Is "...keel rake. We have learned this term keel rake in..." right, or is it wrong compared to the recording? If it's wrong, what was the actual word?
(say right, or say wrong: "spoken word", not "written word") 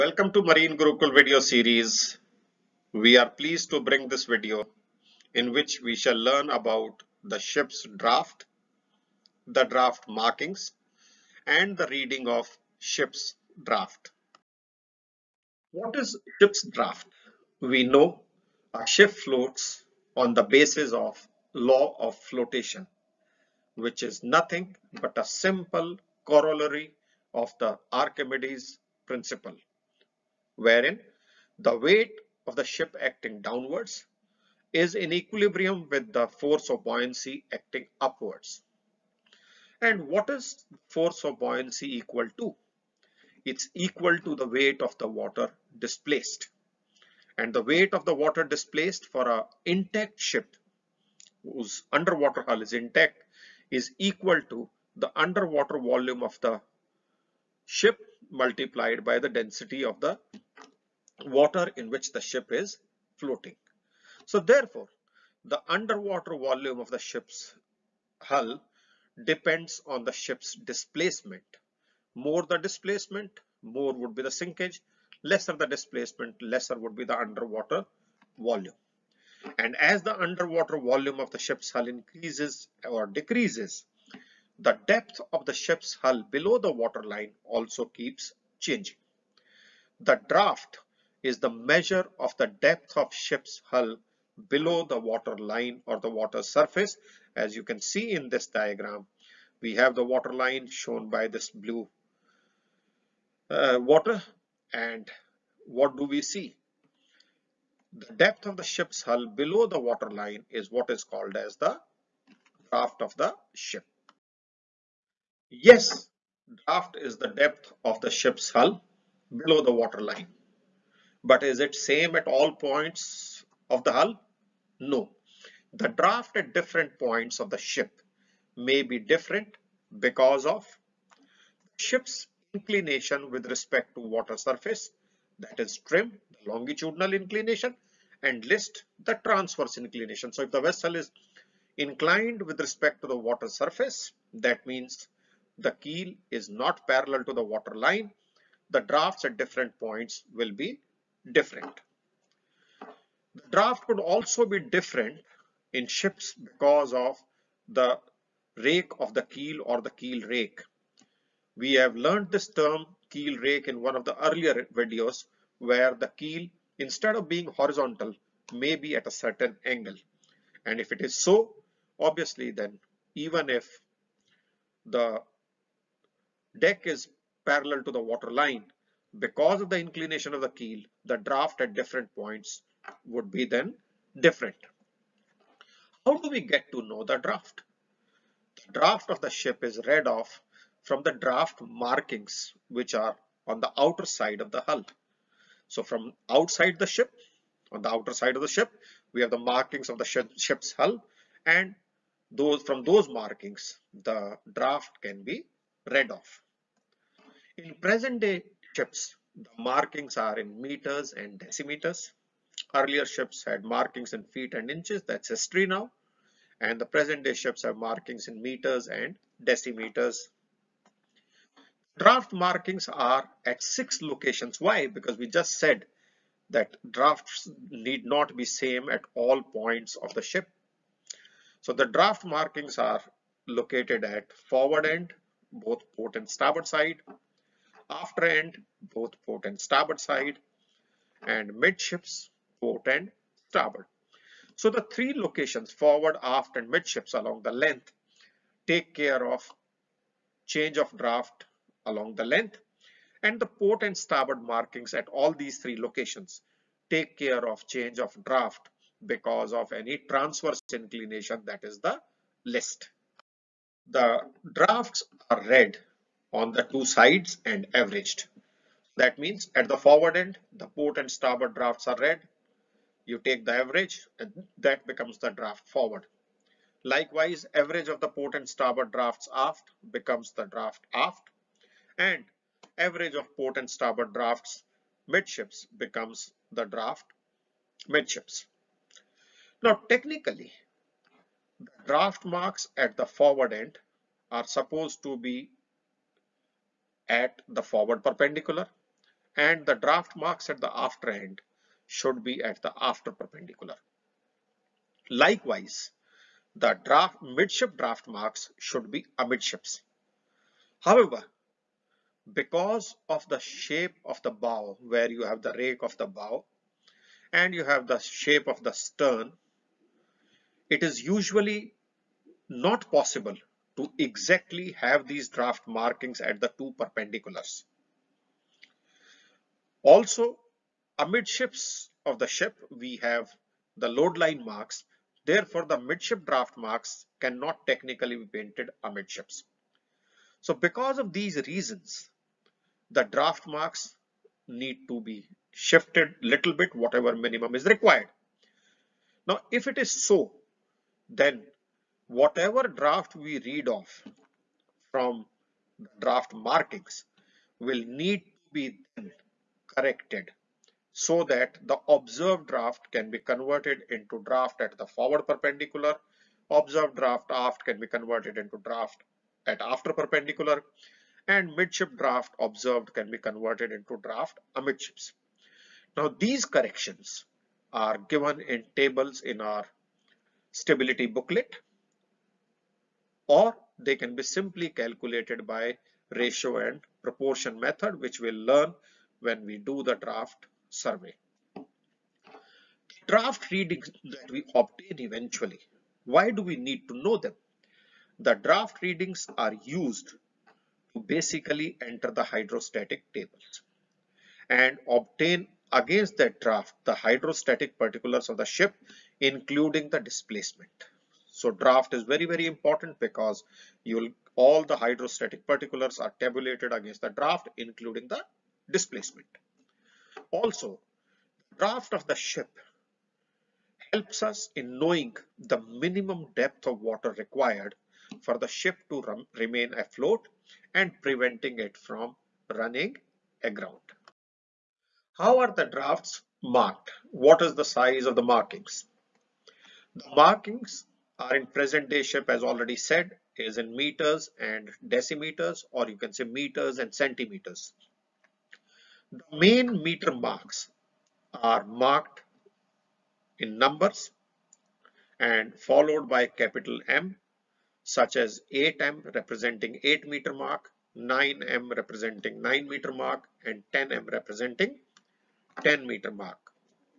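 right.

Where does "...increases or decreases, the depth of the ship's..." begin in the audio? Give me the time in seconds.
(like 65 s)
81 s.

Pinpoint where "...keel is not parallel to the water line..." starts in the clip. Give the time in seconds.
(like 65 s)
145 s.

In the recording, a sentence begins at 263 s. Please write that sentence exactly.
The drafts are read on the two sides and averaged.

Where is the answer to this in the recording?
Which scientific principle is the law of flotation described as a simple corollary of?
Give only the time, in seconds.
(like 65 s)
27 s.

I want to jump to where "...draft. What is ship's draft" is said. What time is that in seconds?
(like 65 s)
13 s.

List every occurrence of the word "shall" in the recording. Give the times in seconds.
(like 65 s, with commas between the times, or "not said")
5 s.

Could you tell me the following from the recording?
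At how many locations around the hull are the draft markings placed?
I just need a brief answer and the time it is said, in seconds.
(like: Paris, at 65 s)
6, at 223 s.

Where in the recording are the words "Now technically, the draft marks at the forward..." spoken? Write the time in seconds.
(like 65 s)
289 s.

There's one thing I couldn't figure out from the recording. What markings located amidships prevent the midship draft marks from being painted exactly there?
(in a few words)
Load line marks.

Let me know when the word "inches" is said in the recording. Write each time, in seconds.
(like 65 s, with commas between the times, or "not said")
214 s.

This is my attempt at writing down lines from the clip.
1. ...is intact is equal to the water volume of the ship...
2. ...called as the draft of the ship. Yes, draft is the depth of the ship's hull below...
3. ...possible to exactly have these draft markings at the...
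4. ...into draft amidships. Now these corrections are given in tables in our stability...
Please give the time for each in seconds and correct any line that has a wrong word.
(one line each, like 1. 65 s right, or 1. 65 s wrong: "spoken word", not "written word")
1. 52 s wrong: "underwater", not "water"
2. 111 s right
3. 322 s right
4. 373 s right.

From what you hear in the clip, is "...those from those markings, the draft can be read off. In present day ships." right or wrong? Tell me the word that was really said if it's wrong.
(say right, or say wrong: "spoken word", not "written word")
right.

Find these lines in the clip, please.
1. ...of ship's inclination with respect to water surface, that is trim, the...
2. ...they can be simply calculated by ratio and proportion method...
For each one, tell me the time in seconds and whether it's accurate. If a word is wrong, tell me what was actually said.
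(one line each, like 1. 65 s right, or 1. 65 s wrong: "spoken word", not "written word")
1. 130 s right
2. 383 s right.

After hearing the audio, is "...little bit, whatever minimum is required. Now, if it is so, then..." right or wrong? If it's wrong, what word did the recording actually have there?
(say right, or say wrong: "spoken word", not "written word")
right.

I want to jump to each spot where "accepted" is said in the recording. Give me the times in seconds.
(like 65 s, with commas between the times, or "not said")
not said.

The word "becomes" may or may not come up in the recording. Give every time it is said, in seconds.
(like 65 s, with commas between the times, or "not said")
274 s, 279 s, 285 s.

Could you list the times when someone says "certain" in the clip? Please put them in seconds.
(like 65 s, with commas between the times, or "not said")
169 s.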